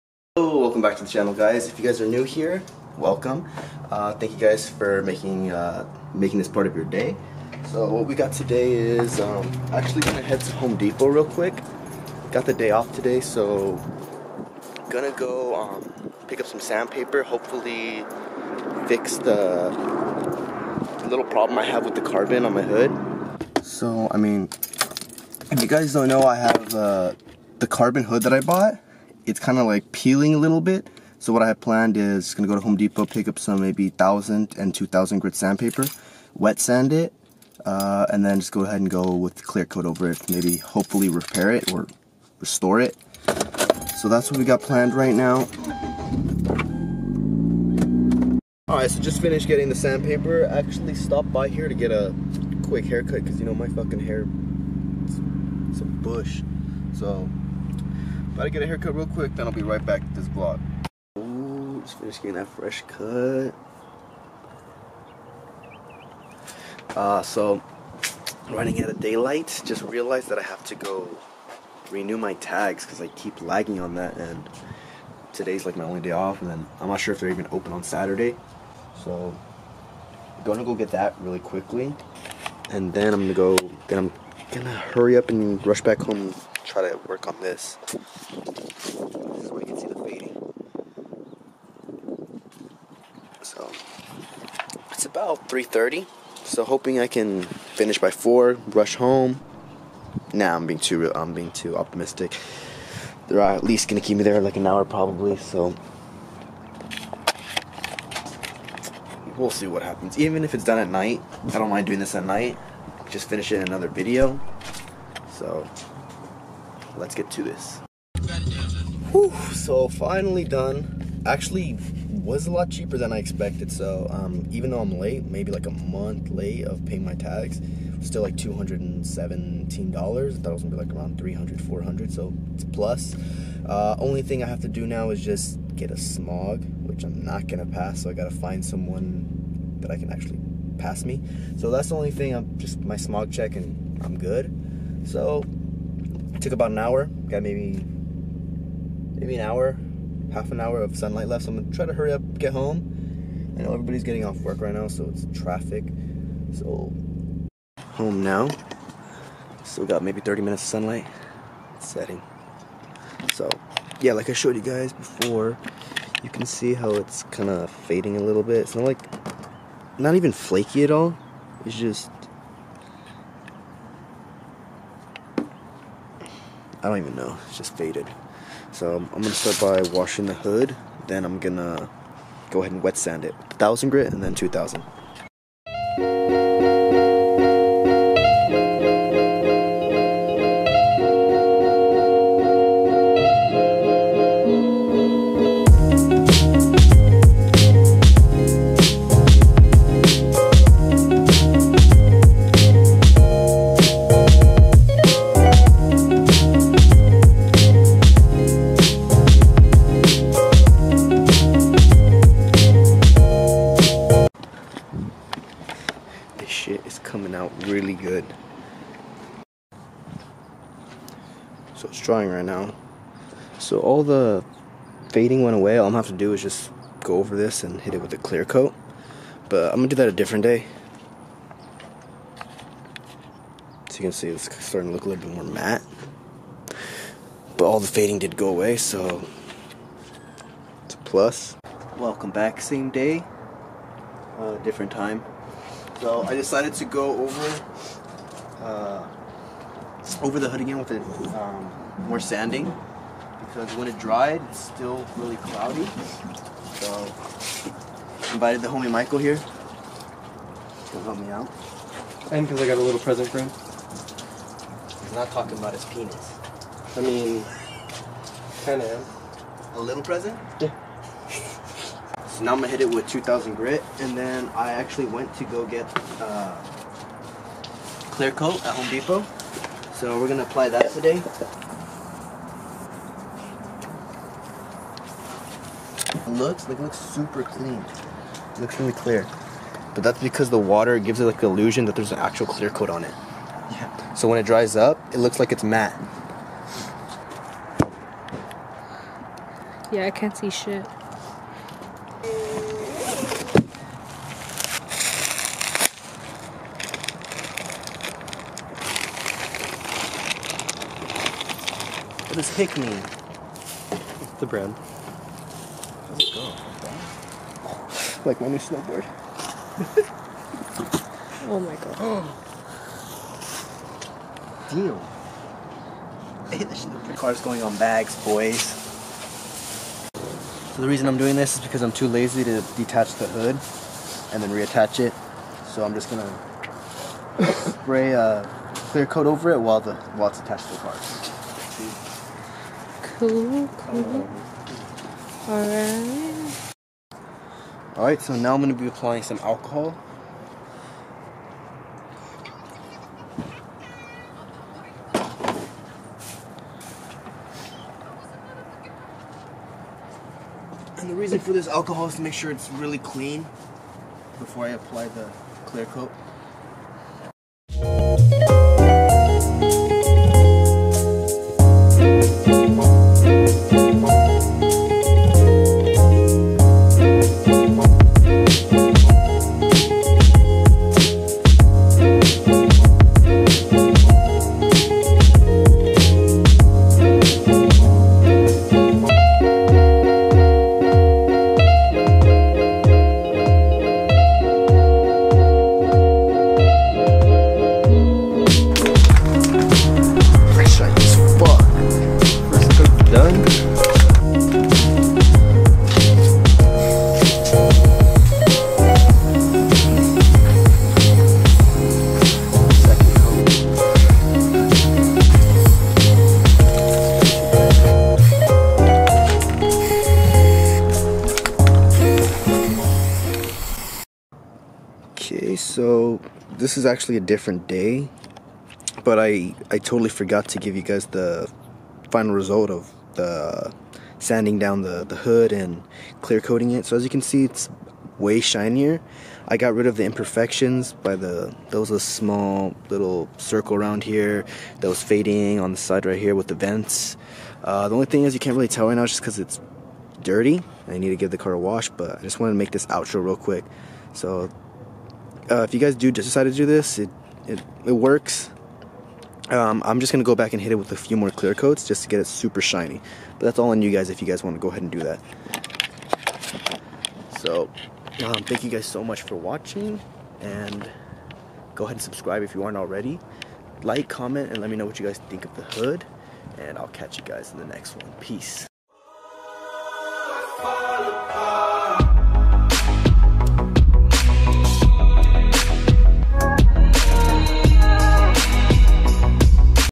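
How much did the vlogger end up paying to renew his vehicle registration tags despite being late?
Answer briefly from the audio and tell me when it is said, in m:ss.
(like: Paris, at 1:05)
$217, at 2:08.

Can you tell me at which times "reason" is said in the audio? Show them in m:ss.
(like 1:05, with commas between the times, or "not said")
5:30, 6:01.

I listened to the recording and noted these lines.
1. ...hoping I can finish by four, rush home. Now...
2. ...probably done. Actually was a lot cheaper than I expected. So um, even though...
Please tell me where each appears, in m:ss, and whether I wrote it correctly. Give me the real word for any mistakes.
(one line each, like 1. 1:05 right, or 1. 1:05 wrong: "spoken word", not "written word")
1. 1:36 right
2. 1:59 wrong: "finally", not "probably".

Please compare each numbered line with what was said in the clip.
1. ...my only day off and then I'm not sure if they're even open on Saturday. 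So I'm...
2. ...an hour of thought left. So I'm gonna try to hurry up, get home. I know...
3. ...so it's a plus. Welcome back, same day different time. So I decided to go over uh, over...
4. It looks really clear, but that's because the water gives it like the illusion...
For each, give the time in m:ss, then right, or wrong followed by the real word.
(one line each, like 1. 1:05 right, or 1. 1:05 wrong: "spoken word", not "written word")
1. 1:15 right
2. 2:30 wrong: "sunlight", not "thought"
3. 3:58 right
4. 4:48 right.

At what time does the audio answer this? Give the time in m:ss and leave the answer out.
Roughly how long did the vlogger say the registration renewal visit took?
2:26.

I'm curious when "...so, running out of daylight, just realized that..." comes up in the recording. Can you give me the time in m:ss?
1:07.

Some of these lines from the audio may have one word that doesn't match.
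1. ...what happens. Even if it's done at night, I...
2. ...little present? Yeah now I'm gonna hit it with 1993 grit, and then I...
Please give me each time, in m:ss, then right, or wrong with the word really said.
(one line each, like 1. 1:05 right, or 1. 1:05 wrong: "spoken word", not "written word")
1. 1:49 right
2. 4:29 wrong: "2000", not "1993".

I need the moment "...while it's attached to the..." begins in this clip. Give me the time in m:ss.
5:40.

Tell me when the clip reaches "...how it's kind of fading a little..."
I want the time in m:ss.
2:46.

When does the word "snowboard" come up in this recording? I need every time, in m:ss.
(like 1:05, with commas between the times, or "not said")
5:18, 5:26.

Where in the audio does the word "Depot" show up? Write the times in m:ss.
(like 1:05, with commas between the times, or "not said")
0:10, 0:32, 4:38.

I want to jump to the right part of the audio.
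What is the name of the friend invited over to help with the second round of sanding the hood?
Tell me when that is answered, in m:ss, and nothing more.
4:18.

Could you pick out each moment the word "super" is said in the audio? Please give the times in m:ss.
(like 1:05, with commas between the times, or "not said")
4:46, 7:42.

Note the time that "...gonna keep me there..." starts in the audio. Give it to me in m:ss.
1:43.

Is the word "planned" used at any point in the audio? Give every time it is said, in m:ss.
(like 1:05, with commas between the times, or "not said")
0:31, 0:44.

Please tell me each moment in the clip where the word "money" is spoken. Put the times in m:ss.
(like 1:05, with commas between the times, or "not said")
not said.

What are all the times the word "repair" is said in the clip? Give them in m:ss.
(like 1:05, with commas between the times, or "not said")
0:41.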